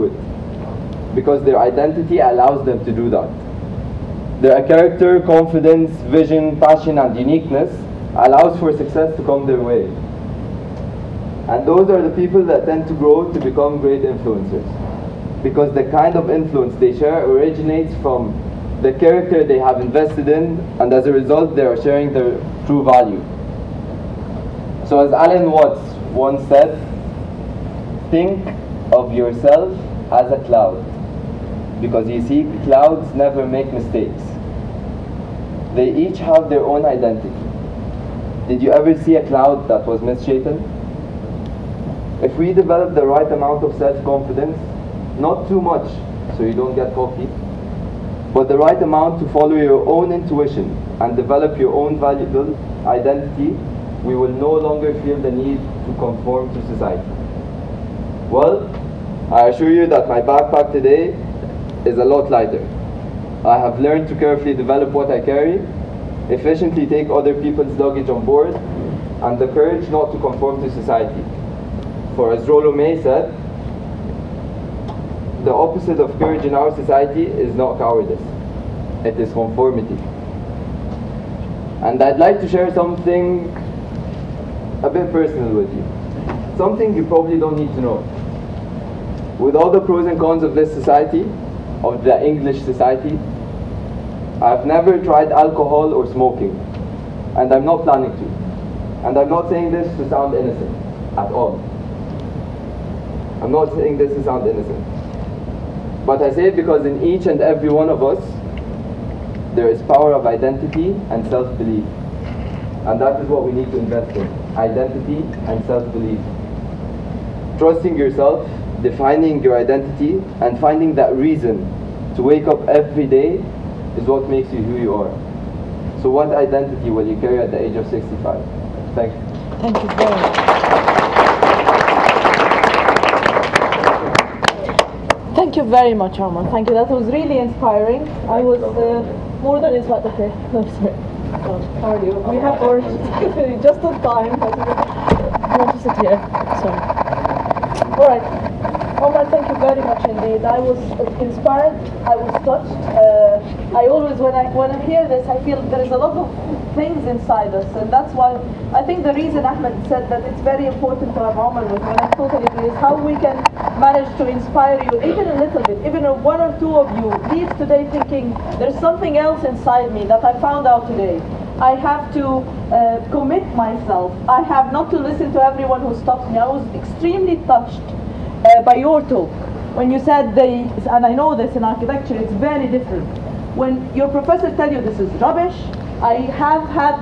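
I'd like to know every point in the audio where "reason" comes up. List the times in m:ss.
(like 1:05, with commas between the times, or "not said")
2:01, 2:39.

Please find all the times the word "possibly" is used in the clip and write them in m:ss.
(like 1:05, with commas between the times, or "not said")
not said.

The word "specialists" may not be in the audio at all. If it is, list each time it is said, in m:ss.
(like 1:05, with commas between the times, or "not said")
not said.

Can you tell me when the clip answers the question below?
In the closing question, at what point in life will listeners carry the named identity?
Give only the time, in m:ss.
2:07.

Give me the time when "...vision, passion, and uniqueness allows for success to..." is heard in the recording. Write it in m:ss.
0:06.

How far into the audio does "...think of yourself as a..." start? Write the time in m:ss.
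0:28.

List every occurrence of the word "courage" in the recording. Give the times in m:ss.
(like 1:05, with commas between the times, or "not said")
1:09, 1:16.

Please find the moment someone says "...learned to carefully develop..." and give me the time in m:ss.
1:03.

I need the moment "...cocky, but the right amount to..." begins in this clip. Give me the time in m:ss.
0:46.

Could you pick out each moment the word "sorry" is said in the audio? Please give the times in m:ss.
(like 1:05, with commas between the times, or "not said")
2:20, 2:26.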